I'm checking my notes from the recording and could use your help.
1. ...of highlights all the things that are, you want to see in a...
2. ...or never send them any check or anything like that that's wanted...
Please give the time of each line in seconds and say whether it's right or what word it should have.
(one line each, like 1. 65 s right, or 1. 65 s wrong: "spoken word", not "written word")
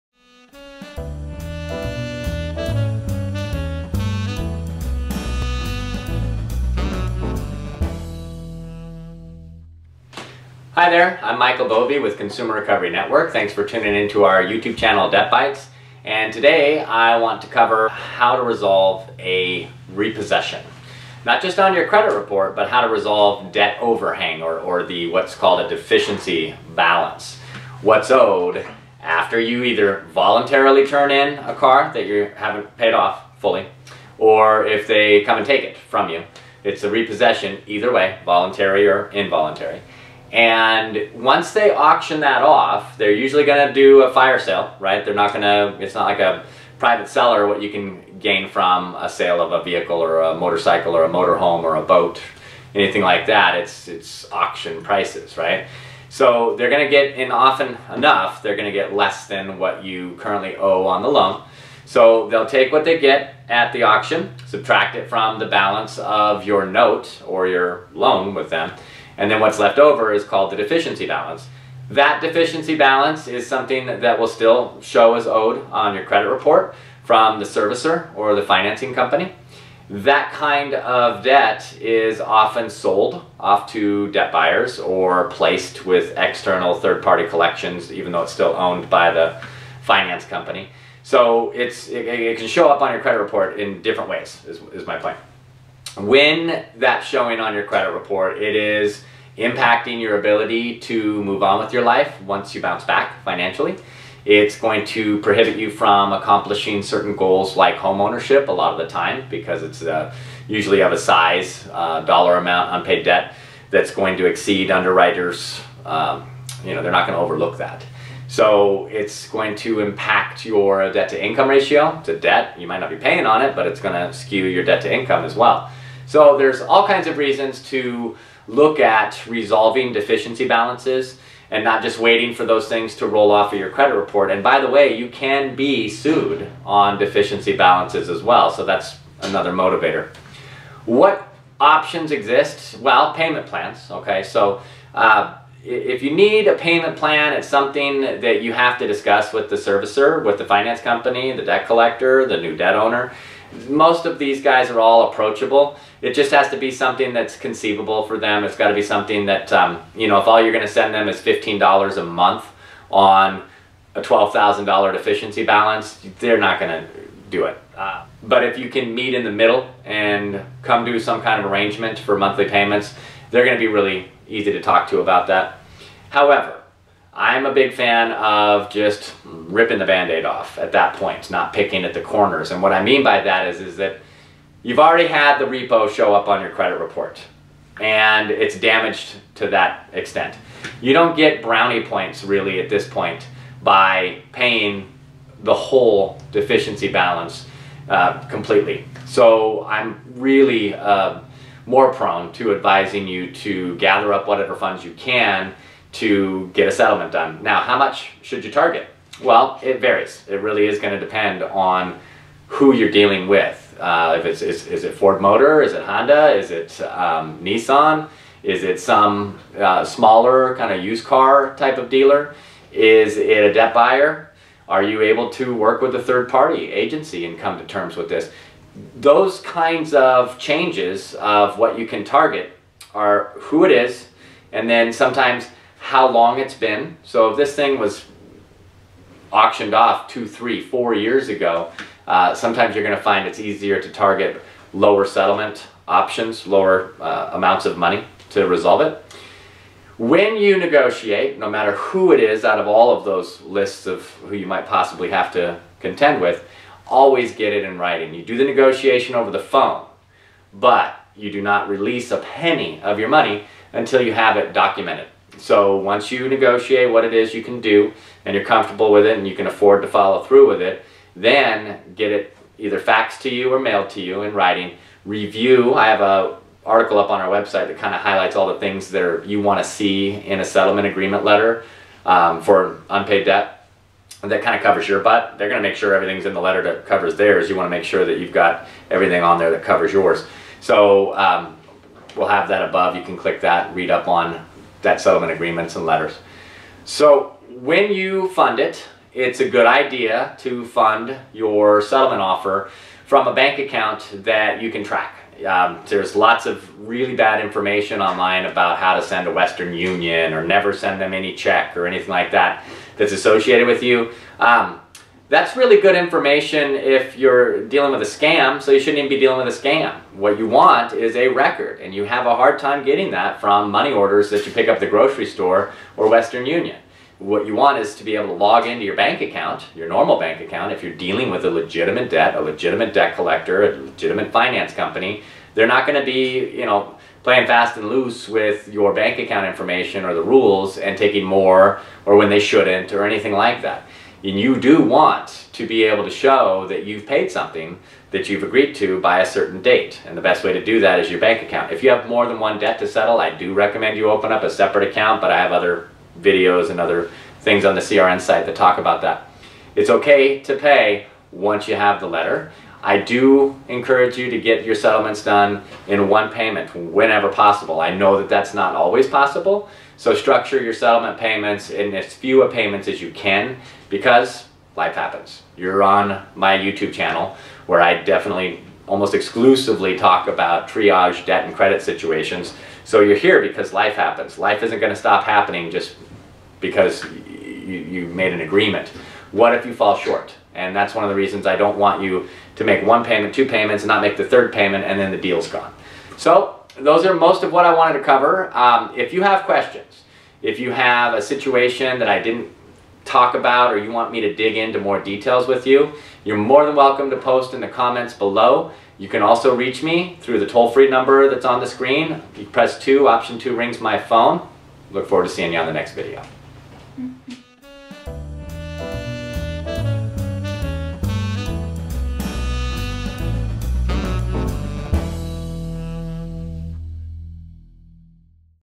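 1. 277 s right
2. 310 s wrong: "associated", not "wanted".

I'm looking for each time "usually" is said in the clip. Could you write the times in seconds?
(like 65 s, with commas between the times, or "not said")
43 s, 110 s.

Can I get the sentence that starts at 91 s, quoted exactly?
So it's, it, it, can show up on your credit report in different ways, is, is my point.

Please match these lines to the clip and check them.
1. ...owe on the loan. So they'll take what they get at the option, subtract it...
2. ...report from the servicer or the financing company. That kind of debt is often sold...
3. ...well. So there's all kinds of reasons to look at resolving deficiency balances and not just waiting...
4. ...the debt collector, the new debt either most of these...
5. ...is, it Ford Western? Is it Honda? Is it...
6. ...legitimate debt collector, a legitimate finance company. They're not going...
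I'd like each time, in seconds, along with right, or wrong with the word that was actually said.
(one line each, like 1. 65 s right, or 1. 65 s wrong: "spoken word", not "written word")
1. 60 s wrong: "auction", not "option"
2. 76 s right
3. 125 s right
4. 151 s wrong: "owner", not "either"
5. 214 s wrong: "Motor", not "Western"
6. 332 s right.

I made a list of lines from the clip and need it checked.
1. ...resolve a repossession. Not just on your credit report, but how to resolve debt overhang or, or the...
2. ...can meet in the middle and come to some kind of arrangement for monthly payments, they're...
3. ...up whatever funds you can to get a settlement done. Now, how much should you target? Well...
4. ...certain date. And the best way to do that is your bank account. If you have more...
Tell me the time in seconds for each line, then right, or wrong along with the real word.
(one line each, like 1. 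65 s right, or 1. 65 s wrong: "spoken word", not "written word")
1. 18 s right
2. 168 s right
3. 204 s right
4. 349 s right.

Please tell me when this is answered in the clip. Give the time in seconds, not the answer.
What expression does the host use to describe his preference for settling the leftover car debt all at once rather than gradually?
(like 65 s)
179 s.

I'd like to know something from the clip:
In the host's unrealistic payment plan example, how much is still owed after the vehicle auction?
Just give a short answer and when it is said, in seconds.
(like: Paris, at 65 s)
$12,000, at 164 s.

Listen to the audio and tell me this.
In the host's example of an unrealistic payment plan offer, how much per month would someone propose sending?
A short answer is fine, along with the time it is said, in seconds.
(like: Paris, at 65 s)
$15, at 161 s.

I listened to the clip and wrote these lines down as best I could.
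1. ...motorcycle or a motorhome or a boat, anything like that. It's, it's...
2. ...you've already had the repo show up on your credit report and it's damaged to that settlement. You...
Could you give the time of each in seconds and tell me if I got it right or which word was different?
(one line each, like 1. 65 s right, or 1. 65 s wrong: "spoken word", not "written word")
1. 50 s right
2. 184 s wrong: "extent", not "settlement".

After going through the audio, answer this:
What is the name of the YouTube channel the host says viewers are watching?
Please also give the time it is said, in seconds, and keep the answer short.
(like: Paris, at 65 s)
DebtBytes, at 15 s.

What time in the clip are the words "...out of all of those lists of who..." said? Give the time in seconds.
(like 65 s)
252 s.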